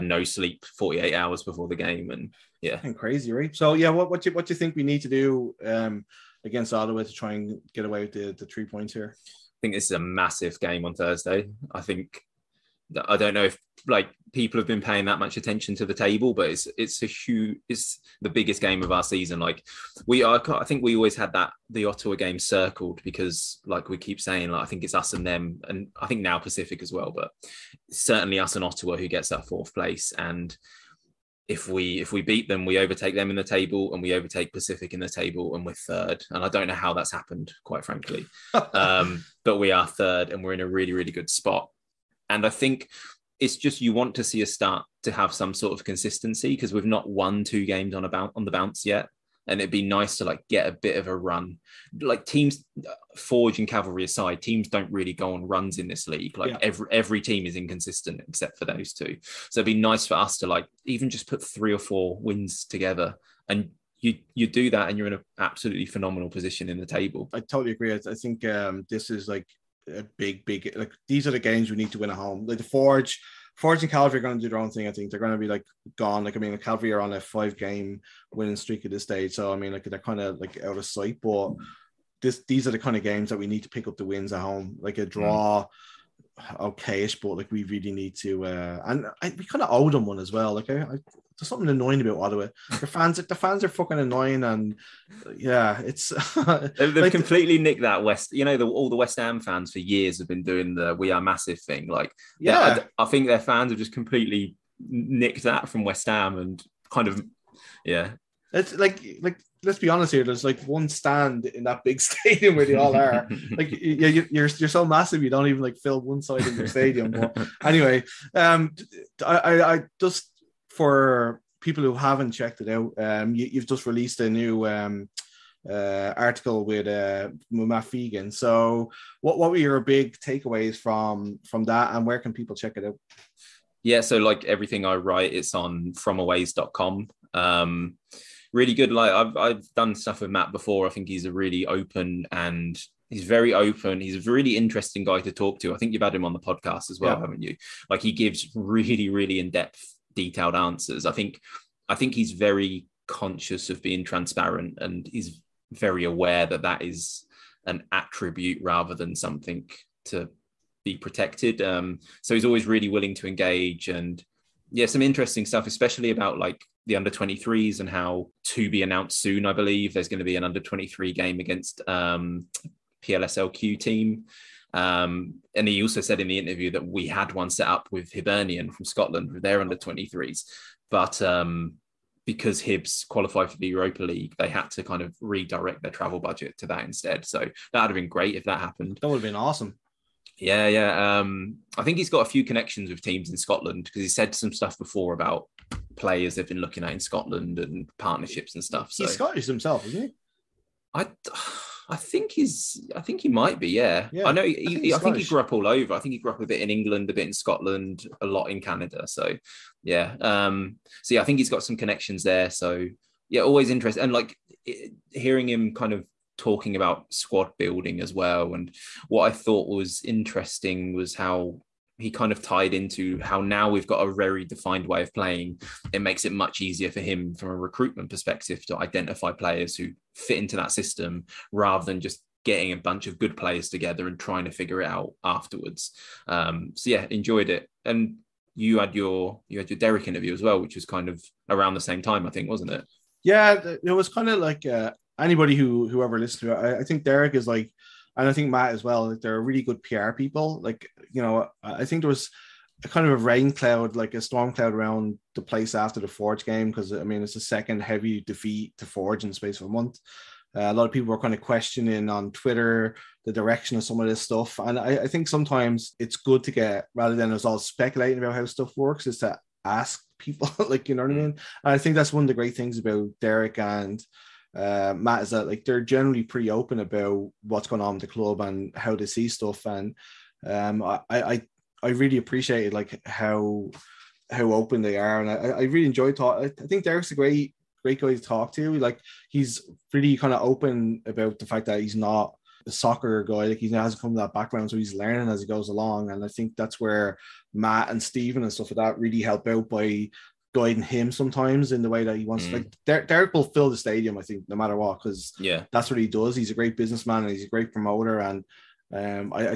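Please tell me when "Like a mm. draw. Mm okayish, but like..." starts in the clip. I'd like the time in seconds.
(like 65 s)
84 s.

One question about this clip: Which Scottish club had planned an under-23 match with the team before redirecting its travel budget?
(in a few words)
Hibernian.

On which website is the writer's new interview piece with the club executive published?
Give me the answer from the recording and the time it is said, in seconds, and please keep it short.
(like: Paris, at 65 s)
fromaways.com, at 135 s.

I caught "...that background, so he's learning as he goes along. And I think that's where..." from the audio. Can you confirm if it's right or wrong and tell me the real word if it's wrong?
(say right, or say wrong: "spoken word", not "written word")
right.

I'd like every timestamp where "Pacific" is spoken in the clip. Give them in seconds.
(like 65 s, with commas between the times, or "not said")
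26 s, 34 s.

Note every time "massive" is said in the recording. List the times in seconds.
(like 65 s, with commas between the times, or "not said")
9 s, 101 s, 114 s.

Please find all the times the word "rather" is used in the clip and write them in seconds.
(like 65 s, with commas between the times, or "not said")
158 s, 231 s, 266 s.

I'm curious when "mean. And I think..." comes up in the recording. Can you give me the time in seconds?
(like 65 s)
271 s.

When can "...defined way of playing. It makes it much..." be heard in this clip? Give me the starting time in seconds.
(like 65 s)
224 s.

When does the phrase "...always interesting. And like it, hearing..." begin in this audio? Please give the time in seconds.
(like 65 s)
213 s.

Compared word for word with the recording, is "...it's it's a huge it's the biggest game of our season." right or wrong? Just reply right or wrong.
right.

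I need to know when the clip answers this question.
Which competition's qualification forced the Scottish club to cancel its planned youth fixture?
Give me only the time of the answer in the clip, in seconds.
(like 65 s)
183 s.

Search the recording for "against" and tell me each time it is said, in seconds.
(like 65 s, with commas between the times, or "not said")
6 s, 171 s.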